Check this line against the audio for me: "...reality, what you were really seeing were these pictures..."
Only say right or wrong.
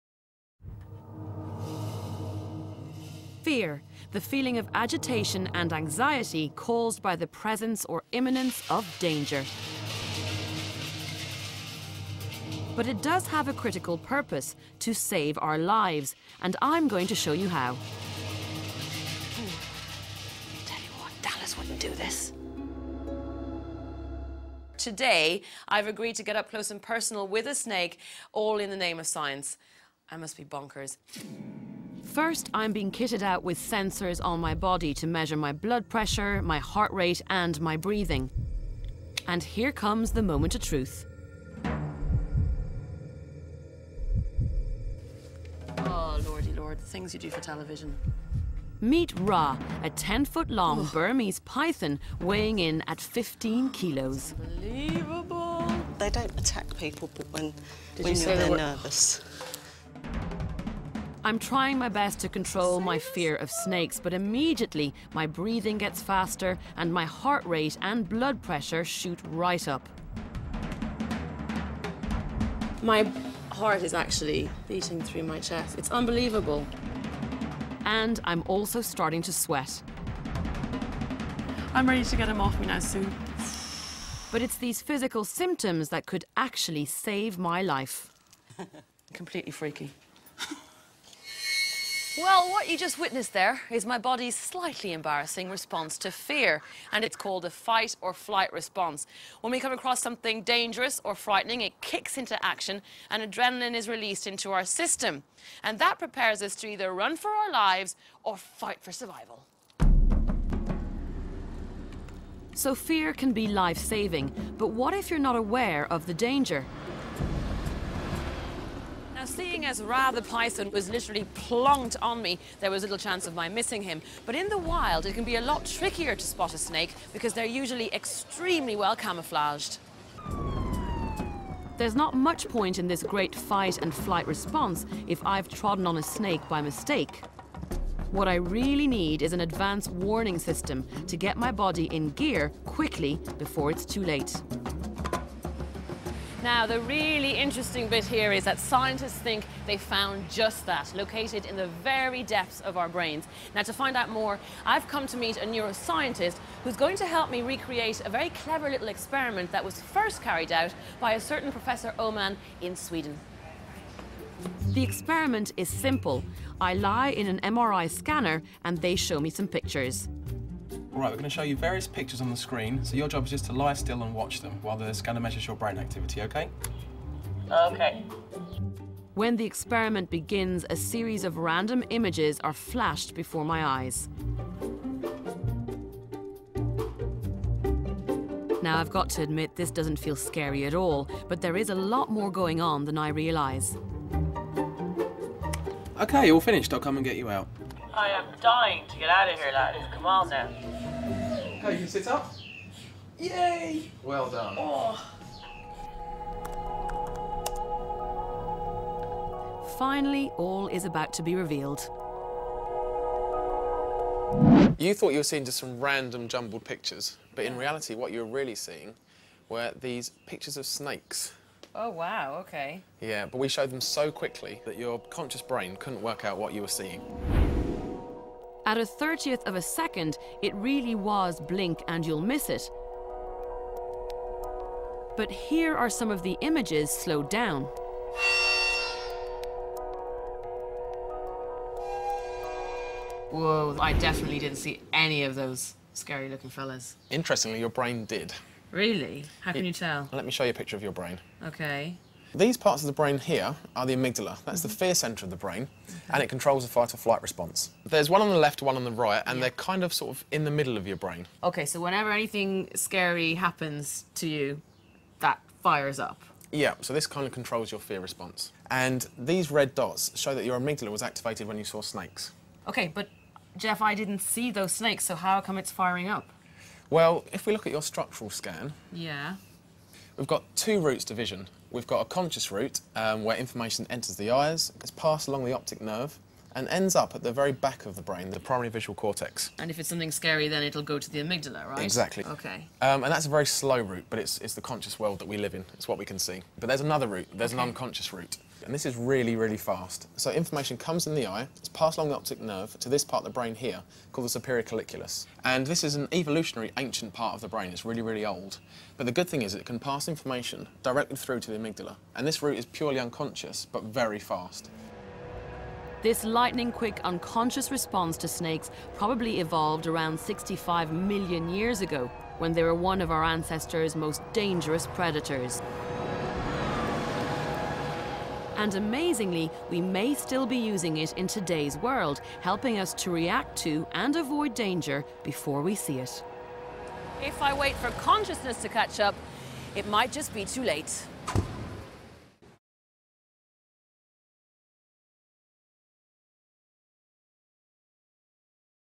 right.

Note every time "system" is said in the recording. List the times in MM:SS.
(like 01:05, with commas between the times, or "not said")
01:44, 02:20.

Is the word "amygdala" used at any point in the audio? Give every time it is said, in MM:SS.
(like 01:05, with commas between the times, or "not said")
04:13, 04:30, 04:51, 05:11.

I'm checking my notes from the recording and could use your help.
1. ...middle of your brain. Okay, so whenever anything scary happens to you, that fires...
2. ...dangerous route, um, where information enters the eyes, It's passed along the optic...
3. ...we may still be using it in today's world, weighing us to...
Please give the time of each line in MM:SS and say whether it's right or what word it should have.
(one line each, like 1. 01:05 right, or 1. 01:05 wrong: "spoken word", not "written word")
1. 04:20 right
2. 04:42 wrong: "conscious", not "dangerous"
3. 05:29 wrong: "helping", not "weighing".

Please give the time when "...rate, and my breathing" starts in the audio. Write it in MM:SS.
00:36.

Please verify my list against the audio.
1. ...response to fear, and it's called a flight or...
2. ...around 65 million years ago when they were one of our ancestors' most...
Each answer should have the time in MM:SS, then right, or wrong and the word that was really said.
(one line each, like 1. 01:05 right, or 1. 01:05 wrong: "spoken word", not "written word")
1. 01:35 wrong: "fight", not "flight"
2. 05:19 right.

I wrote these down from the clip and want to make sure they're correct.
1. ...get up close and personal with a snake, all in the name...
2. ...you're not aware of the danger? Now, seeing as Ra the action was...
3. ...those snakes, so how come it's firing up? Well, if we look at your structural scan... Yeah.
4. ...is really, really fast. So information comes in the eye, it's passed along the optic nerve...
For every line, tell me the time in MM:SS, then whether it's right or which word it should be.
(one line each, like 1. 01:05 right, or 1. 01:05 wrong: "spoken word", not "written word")
1. 00:26 right
2. 01:55 wrong: "python", not "action"
3. 04:34 right
4. 04:58 right.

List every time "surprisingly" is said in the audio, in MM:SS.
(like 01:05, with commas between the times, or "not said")
not said.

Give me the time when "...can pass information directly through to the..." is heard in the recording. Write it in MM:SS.
05:09.